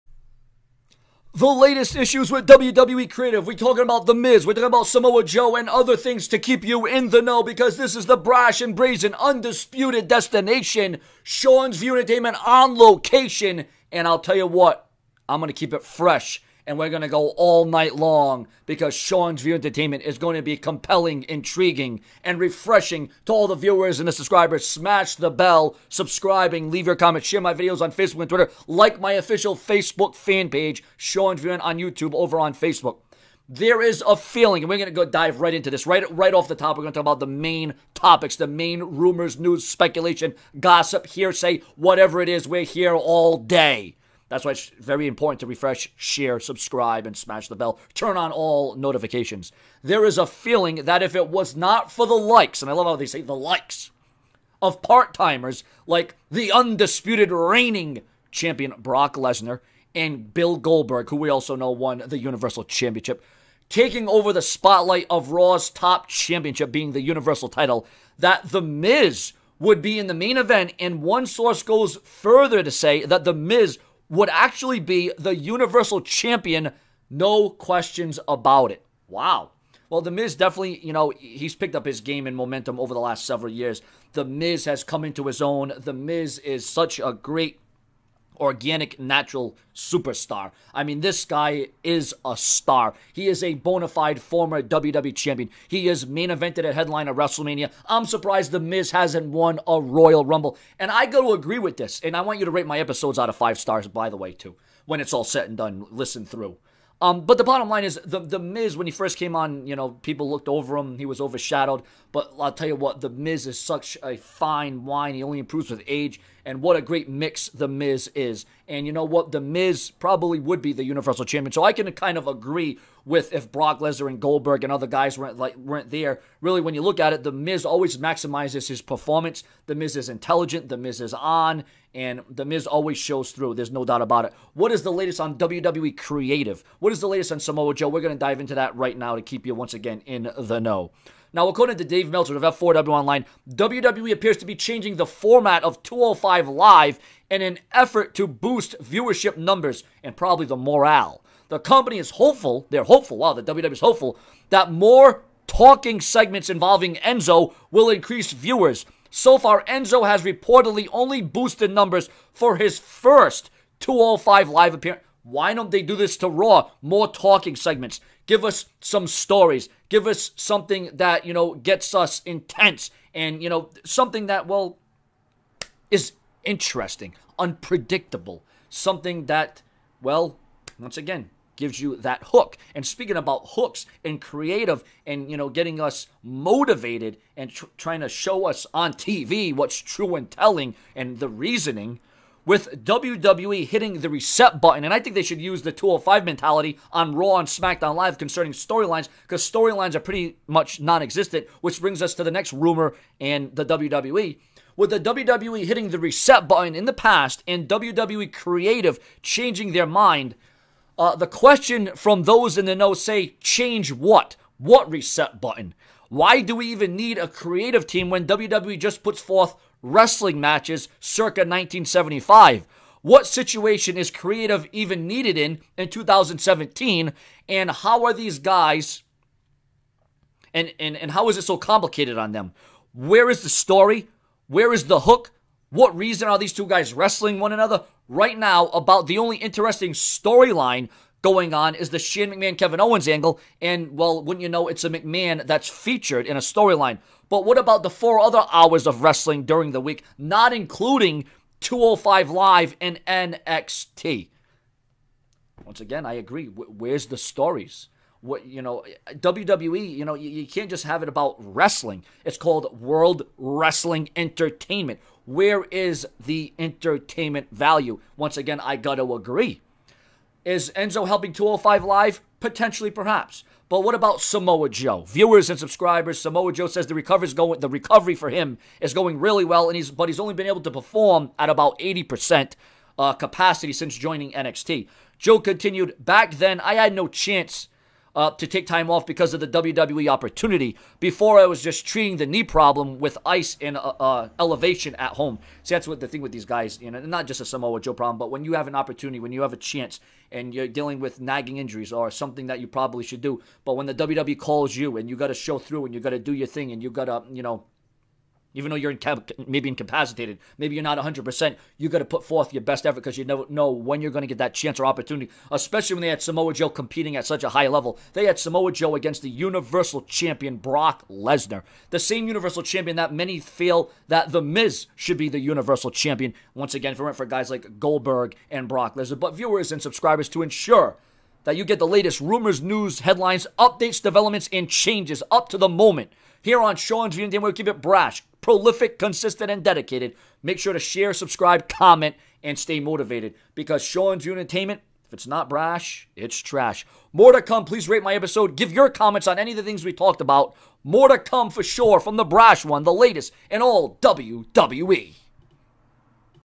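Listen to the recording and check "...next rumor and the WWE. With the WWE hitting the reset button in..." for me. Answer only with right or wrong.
right.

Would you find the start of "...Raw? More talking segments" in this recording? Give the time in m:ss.
2:46.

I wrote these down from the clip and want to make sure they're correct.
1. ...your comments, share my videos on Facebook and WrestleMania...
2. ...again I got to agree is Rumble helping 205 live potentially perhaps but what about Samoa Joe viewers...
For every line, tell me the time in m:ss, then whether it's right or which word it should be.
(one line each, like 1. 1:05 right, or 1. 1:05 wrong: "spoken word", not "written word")
1. 0:26 wrong: "Twitter", not "WrestleMania"
2. 4:28 wrong: "Enzo", not "Rumble".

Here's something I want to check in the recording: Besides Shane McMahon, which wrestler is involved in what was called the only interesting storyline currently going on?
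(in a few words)
Kevin Owens.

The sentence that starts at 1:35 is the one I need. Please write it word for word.
He is main evented at headline of WrestleMania.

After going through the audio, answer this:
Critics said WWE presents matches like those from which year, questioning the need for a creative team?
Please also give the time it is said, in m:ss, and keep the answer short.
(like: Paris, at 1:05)
1975, at 3:41.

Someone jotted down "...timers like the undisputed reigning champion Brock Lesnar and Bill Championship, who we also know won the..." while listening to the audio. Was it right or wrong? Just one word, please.
wrong.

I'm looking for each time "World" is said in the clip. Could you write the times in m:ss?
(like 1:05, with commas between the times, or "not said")
4:22.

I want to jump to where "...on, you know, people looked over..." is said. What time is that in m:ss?
1:49.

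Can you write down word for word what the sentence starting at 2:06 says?
Really, when you look at it, the Miz always maximizes his performance.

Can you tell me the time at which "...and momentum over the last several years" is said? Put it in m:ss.
1:22.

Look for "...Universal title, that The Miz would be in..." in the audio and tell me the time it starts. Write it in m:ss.
1:07.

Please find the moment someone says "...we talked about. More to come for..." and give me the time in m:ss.
5:49.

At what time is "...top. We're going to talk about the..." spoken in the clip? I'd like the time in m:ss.
0:36.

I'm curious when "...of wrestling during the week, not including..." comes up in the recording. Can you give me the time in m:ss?
4:08.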